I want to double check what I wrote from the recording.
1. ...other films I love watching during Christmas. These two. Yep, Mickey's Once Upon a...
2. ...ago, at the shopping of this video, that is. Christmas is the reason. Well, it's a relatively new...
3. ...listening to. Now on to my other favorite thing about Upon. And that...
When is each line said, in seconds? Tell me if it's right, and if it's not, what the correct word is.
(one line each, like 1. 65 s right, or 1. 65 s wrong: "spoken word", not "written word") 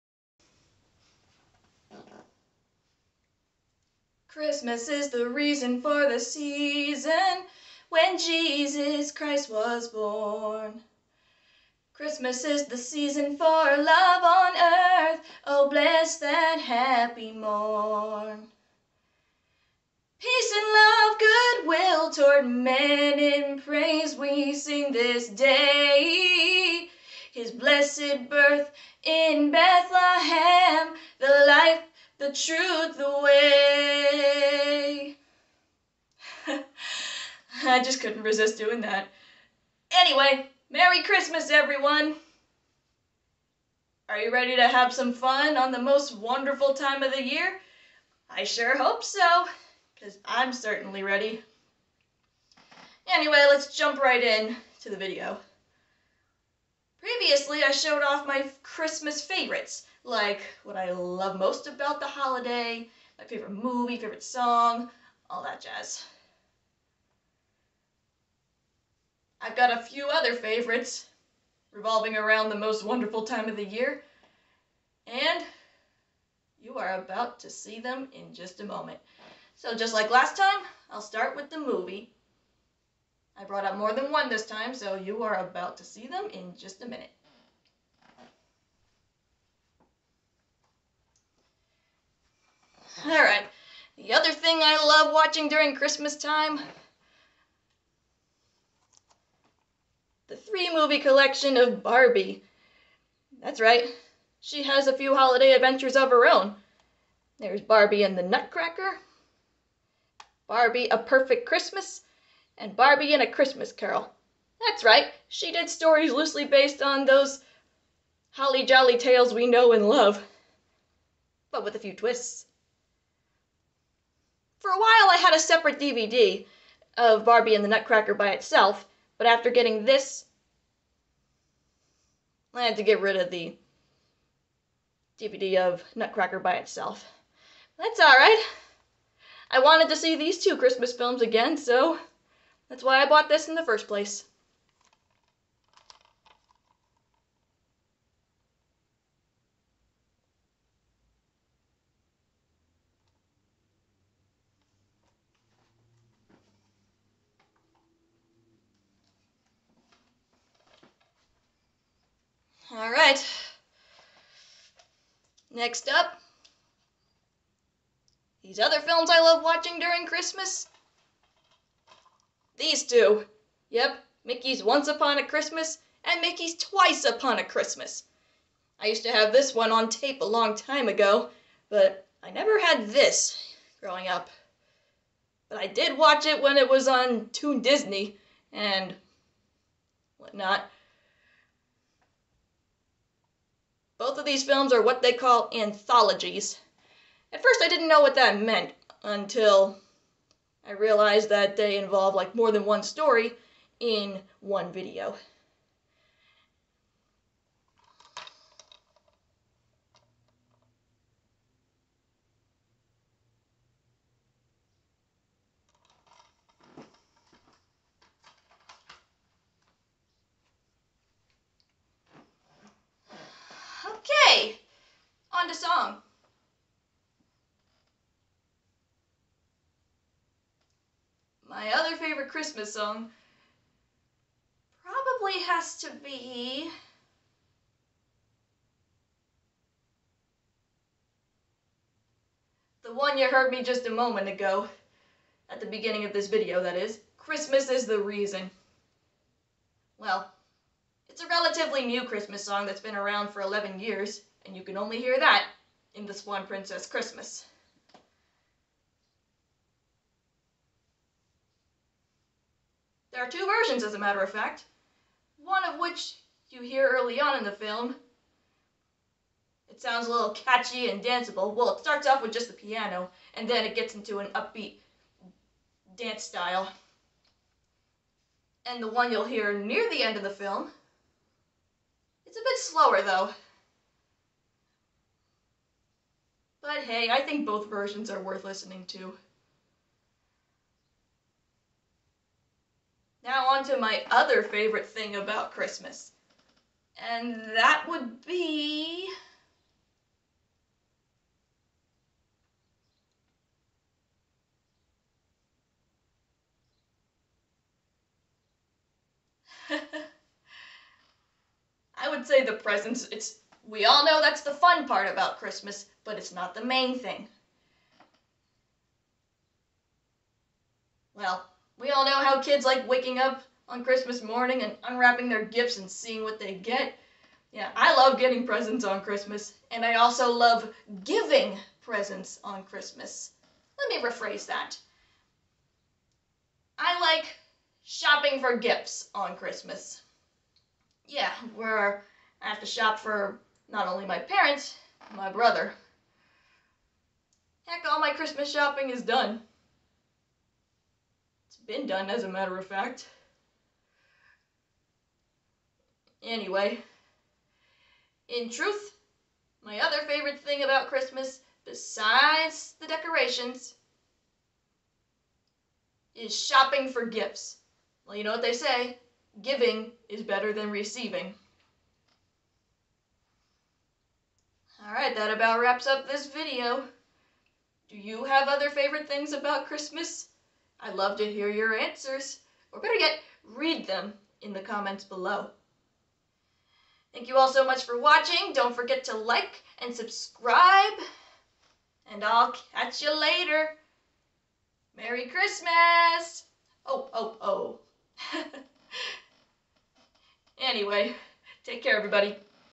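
1. 168 s right
2. 244 s wrong: "beginning", not "shopping"
3. 288 s wrong: "Christmas", not "Upon".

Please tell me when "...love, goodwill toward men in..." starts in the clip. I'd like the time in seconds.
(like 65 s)
20 s.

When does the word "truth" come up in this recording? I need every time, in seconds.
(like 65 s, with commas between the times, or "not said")
32 s, 358 s.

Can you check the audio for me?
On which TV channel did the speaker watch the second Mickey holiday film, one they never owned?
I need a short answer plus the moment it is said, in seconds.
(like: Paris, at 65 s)
Toon Disney, at 187 s.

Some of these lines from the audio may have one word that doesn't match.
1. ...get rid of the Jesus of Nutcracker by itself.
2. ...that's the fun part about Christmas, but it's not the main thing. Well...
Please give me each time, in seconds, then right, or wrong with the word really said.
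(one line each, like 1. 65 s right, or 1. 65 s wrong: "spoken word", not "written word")
1. 132 s wrong: "DVD", not "Jesus"
2. 314 s right.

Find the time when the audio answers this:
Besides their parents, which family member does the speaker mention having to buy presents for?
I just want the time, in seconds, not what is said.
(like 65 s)
345 s.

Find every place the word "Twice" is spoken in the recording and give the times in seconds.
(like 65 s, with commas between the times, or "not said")
176 s.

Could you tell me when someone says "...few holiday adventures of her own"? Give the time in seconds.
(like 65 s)
104 s.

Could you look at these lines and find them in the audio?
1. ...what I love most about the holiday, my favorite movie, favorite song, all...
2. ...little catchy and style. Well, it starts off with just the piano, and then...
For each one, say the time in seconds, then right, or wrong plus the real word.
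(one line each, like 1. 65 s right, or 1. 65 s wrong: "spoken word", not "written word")
1. 60 s right
2. 270 s wrong: "danceable", not "style".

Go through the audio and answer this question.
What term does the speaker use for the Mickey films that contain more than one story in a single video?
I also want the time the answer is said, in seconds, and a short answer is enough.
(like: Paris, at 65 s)
anthologies, at 195 s.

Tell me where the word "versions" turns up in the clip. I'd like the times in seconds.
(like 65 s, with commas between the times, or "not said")
263 s, 287 s.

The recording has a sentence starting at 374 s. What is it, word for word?
Alright, that about wraps up this video.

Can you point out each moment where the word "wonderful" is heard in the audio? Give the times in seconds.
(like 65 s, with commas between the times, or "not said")
46 s, 72 s.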